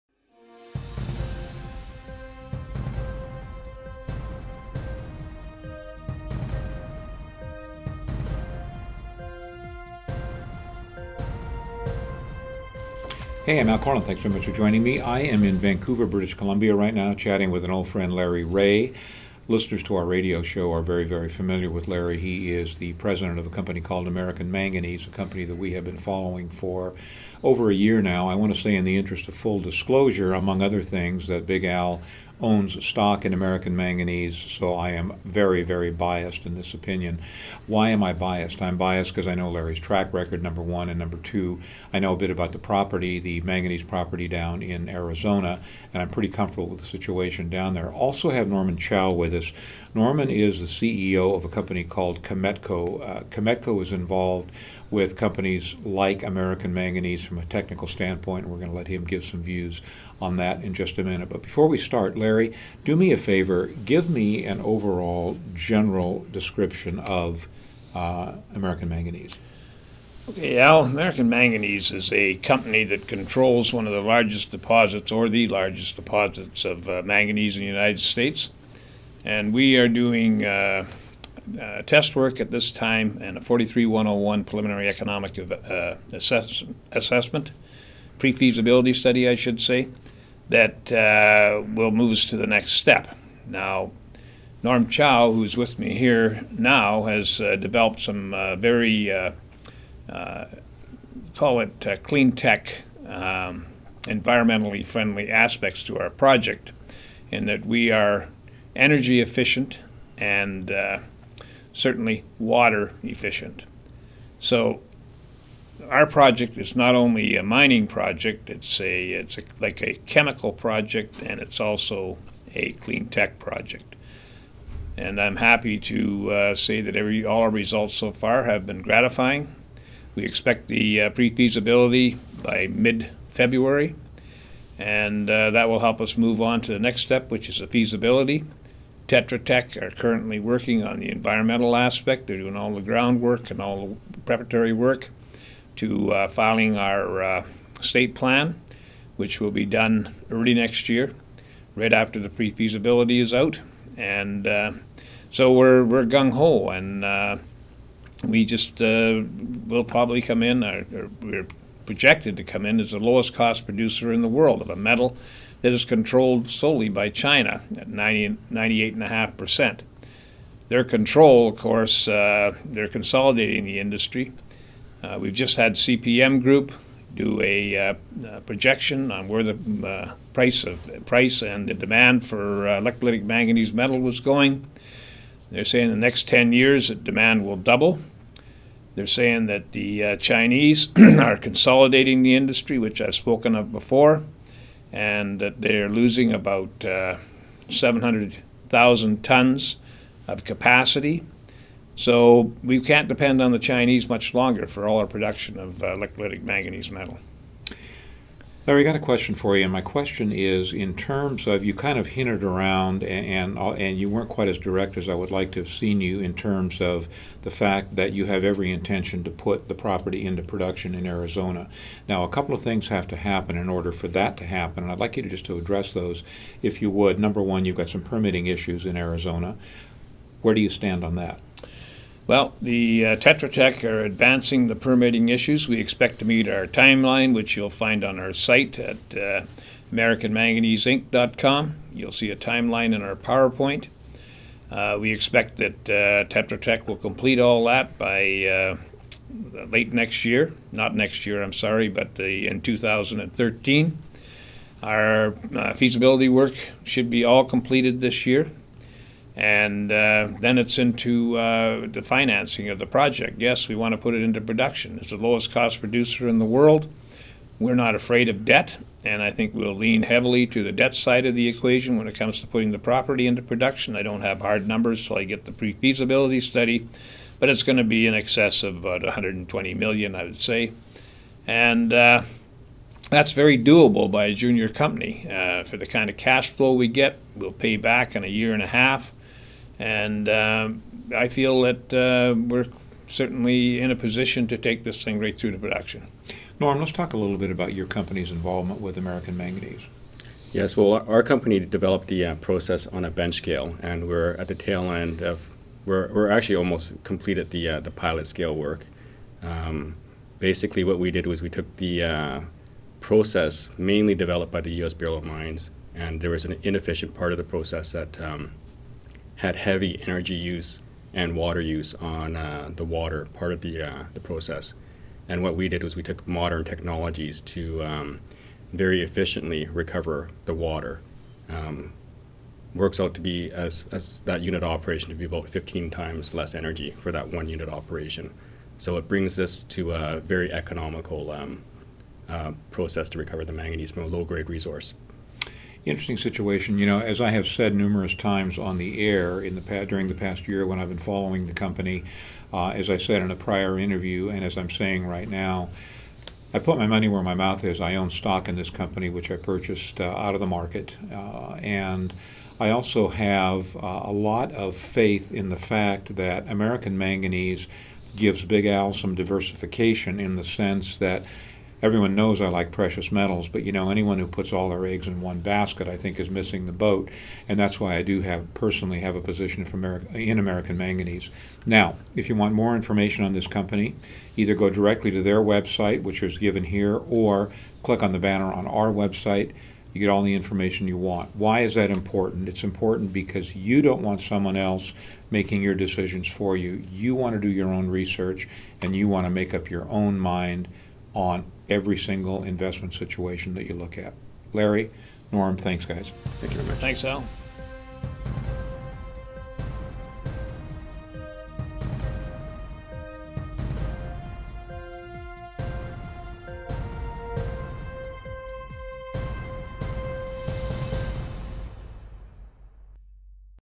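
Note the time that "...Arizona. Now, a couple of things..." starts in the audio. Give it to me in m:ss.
3:41.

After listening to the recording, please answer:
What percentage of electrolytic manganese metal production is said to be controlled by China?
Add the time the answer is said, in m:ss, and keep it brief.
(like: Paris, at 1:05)
98.5%, at 2:48.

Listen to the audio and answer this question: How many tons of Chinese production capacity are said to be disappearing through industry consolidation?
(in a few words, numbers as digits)
700,000 tons.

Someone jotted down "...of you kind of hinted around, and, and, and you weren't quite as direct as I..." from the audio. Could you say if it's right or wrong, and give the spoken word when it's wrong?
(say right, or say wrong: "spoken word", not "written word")
right.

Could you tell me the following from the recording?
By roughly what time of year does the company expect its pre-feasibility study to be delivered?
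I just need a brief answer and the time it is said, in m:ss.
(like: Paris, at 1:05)
mid-February, at 2:12.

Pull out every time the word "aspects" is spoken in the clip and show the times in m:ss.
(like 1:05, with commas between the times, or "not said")
1:45, 2:21.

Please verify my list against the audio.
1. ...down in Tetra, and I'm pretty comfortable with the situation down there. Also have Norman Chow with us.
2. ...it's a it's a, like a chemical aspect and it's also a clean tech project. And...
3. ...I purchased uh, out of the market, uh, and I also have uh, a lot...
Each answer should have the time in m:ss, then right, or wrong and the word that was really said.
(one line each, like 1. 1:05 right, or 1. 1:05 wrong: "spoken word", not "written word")
1. 0:44 wrong: "Arizona", not "Tetra"
2. 1:58 wrong: "project", not "aspect"
3. 5:59 right.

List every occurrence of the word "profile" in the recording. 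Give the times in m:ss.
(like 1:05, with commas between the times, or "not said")
not said.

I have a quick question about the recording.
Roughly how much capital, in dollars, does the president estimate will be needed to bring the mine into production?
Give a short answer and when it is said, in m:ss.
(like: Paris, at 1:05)
120 million, at 4:39.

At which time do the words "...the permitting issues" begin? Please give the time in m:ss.
3:54.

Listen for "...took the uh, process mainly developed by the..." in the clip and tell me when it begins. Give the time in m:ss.
5:11.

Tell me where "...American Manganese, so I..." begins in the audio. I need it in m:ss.
0:33.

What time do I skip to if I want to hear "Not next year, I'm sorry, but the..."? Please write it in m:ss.
4:10.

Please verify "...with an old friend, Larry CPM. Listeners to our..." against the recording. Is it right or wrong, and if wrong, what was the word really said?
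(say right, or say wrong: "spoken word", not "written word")
wrong: "Reaugh", not "CPM".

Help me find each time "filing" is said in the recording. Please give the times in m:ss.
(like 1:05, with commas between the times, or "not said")
2:26.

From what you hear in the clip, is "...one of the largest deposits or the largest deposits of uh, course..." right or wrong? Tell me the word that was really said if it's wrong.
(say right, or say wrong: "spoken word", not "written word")
wrong: "manganese", not "course".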